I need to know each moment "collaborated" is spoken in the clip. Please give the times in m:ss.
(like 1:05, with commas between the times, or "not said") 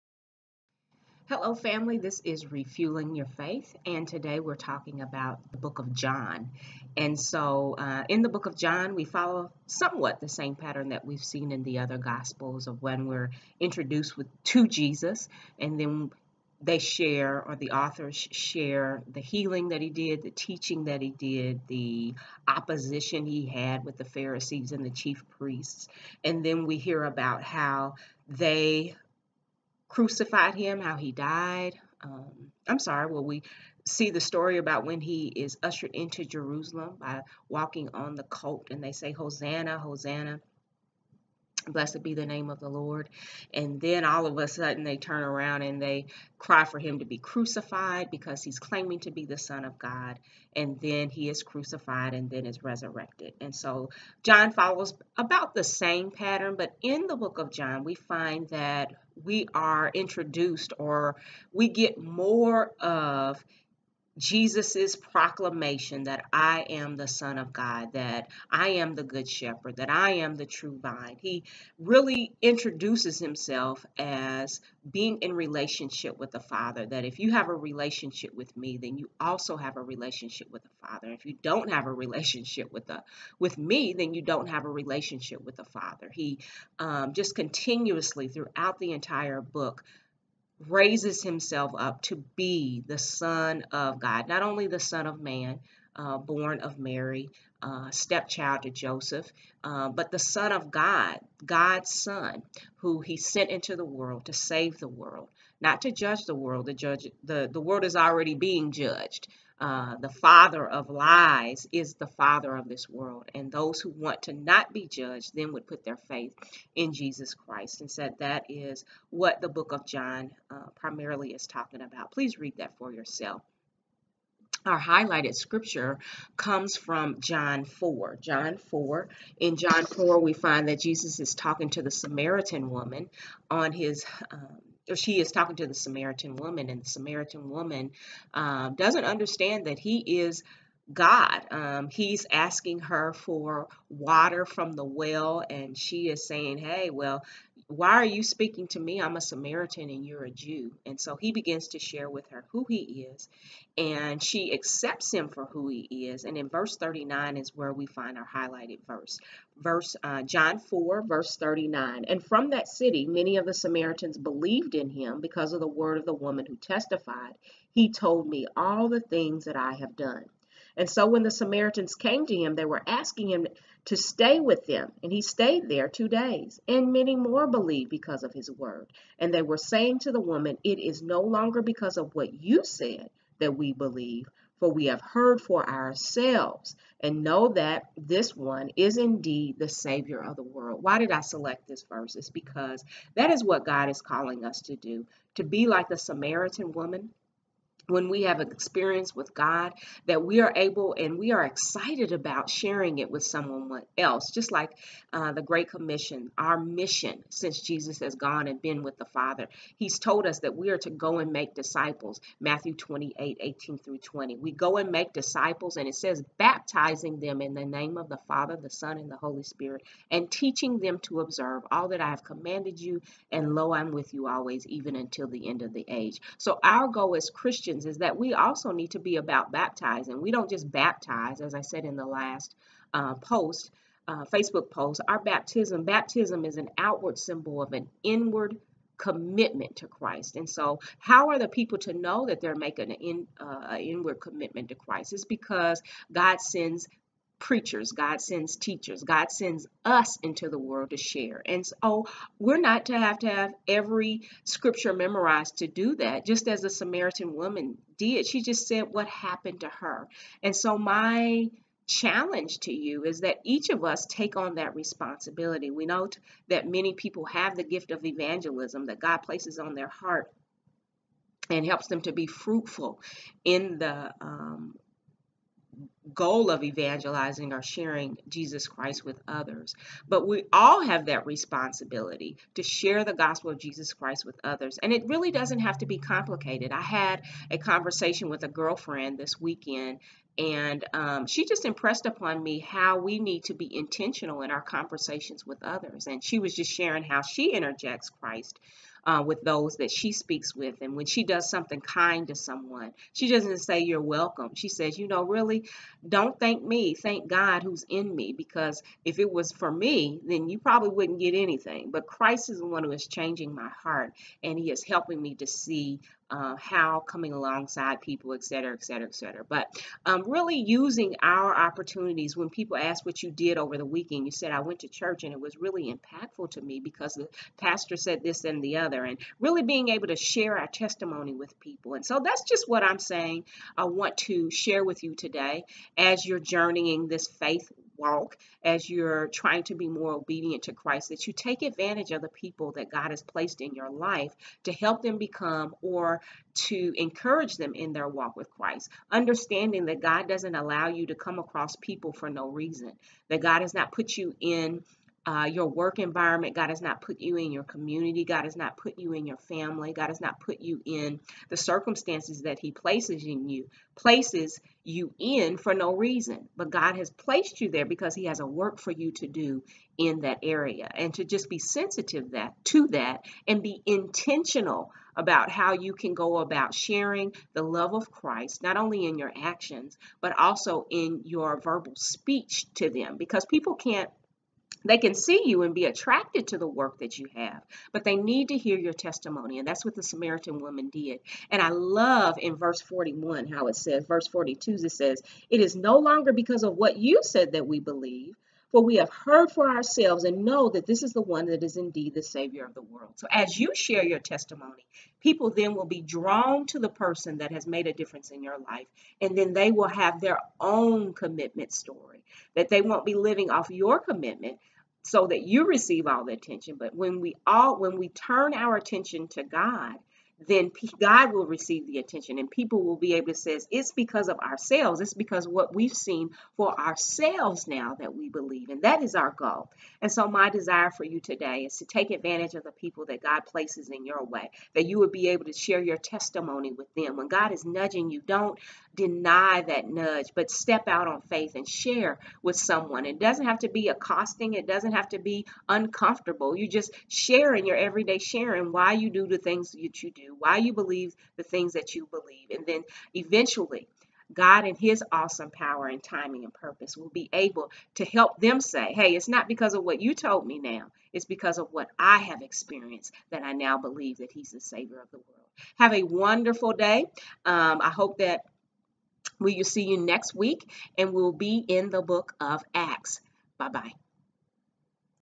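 not said.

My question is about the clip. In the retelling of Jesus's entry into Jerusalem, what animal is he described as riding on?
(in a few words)
colt.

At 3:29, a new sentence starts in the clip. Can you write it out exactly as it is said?
He's told us that we are to go and make disciples, Matthew 28 18 through 20.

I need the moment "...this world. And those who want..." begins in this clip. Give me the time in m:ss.
1:52.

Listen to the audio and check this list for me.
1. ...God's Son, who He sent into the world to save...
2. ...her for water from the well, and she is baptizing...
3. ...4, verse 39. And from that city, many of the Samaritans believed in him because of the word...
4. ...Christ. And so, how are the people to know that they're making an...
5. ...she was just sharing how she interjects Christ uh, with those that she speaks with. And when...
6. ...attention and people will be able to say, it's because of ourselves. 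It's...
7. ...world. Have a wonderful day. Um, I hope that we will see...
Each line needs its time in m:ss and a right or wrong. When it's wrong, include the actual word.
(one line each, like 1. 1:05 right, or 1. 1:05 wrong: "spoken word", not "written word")
1. 1:41 right
2. 2:22 wrong: "saying", not "baptizing"
3. 2:40 right
4. 3:59 right
5. 4:56 right
6. 7:01 right
7. 7:45 right.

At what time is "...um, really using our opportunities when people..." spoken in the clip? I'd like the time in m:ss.
5:20.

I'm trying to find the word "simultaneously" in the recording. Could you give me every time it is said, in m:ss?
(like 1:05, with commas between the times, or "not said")
not said.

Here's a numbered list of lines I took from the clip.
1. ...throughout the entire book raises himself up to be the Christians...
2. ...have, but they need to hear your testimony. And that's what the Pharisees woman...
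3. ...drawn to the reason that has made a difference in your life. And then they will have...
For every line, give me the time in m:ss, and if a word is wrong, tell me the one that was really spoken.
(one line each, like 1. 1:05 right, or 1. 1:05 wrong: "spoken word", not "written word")
1. 1:28 wrong: "Son", not "Christians"
2. 6:27 wrong: "Samaritan", not "Pharisees"
3. 6:46 wrong: "person", not "reason".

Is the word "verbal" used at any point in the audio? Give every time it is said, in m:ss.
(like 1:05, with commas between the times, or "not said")
6:21.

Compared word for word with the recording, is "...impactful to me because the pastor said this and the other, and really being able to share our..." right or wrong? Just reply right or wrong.
right.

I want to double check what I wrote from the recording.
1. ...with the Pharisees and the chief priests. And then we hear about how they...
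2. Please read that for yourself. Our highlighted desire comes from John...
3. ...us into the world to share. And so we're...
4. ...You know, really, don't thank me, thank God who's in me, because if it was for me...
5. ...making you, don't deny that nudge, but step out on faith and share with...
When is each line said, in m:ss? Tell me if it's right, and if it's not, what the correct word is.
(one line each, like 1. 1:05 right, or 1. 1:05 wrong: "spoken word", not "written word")
1. 0:23 right
2. 2:02 wrong: "scripture", not "desire"
3. 4:09 right
4. 5:04 right
5. 7:17 wrong: "nudging", not "making".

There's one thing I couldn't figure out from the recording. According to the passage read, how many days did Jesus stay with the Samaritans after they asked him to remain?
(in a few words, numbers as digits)
2.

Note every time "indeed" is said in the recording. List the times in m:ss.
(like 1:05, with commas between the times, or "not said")
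3:08, 6:41.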